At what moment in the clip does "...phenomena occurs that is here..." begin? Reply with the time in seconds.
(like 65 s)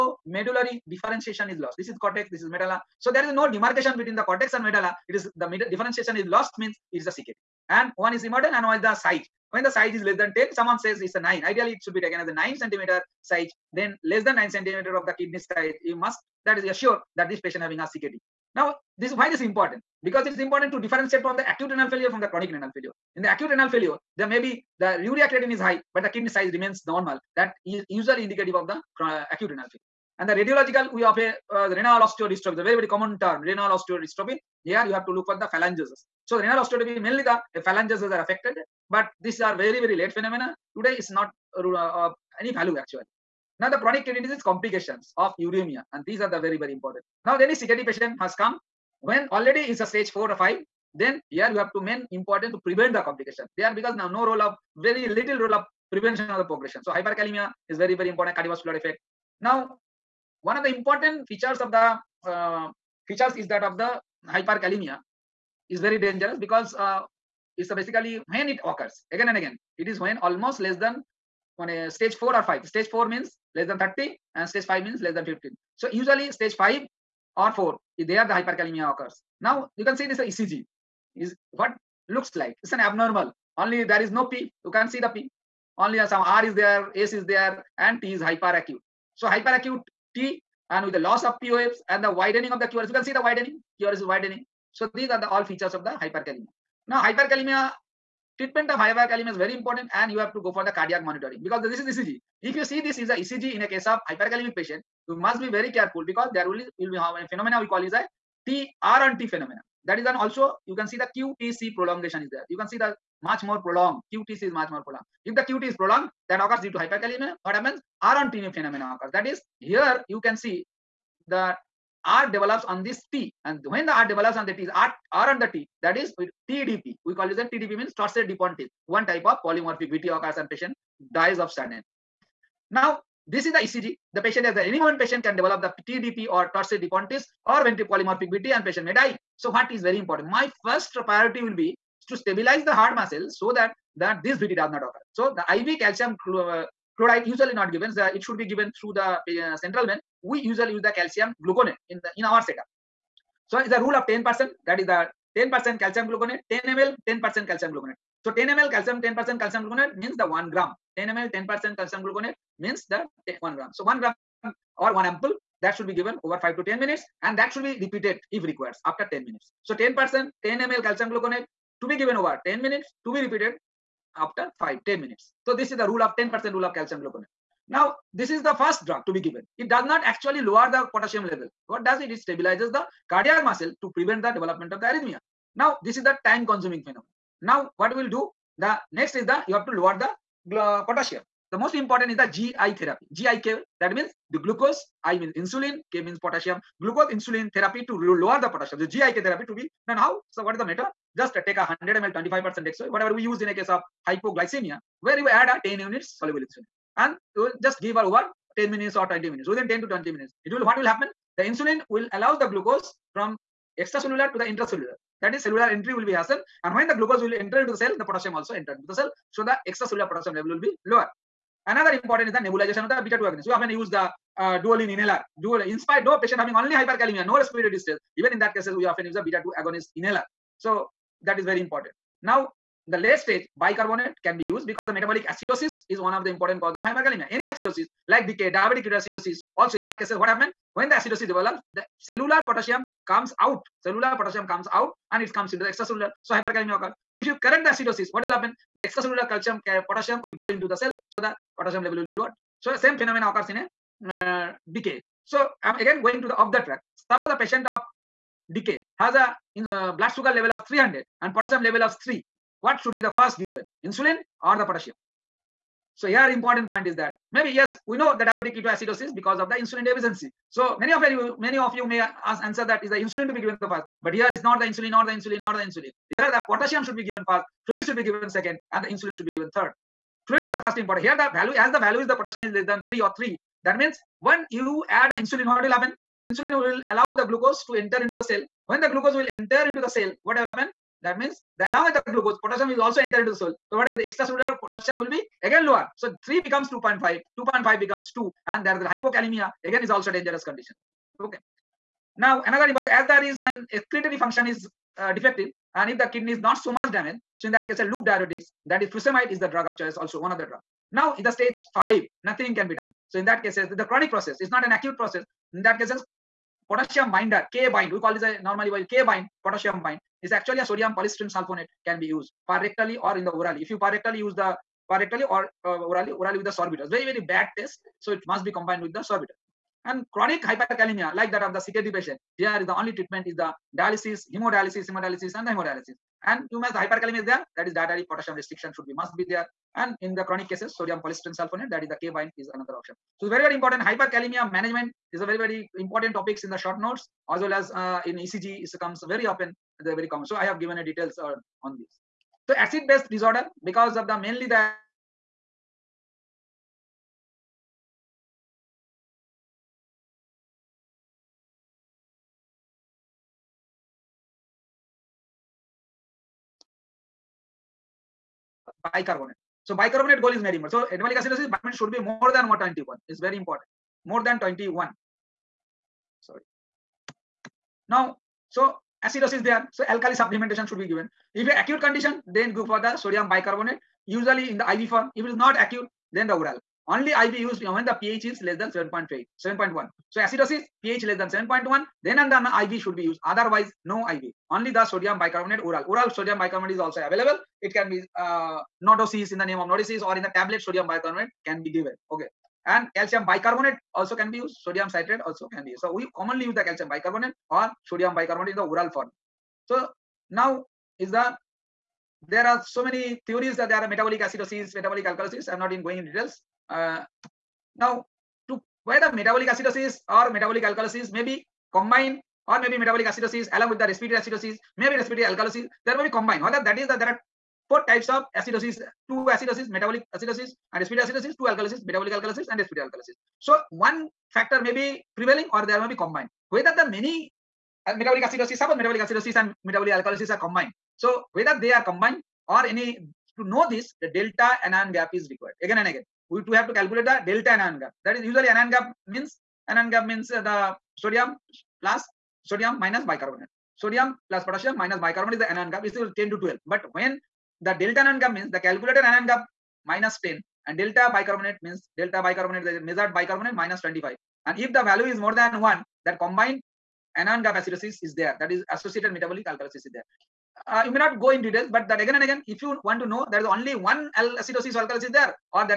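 118 s.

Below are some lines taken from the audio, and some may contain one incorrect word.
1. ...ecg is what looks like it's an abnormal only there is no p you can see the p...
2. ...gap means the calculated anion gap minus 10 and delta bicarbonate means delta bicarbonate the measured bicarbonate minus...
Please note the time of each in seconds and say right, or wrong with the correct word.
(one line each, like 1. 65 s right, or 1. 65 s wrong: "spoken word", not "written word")
1. 80 s right
2. 458 s right.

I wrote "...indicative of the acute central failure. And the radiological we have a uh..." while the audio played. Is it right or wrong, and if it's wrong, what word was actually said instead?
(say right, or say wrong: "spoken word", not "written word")
wrong: "renal", not "central".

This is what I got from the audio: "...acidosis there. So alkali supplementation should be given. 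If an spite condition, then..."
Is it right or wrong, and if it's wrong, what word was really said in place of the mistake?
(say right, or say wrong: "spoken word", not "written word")
wrong: "acute", not "spite".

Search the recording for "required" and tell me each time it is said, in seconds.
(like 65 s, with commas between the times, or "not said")
168 s, 445 s.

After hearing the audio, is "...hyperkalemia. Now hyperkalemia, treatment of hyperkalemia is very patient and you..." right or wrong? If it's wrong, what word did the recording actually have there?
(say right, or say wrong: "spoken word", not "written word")
wrong: "important", not "patient".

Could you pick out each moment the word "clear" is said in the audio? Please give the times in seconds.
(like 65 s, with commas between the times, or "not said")
not said.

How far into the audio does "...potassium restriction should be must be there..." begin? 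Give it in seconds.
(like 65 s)
338 s.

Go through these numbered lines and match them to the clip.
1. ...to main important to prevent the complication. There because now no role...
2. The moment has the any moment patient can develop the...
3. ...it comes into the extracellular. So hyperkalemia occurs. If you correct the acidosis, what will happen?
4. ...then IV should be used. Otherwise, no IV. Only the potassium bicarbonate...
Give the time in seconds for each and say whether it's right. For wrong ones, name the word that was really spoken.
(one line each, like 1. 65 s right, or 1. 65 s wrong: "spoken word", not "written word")
1. 51 s right
2. 134 s wrong: "patient", not "moment"
3. 245 s right
4. 392 s wrong: "sodium", not "potassium".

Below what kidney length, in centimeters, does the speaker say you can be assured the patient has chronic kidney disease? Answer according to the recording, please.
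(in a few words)
9.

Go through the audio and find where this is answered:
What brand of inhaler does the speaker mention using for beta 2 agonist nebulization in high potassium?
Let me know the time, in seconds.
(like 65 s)
224 s.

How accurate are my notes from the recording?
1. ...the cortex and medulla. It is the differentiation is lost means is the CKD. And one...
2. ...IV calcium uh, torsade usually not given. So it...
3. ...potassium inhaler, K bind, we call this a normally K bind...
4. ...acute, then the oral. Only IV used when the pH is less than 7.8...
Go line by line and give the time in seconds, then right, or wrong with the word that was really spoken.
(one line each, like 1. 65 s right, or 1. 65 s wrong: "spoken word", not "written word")
1. 4 s right
2. 145 s wrong: "chloride", not "torsade"
3. 316 s wrong: "binder", not "inhaler"
4. 385 s right.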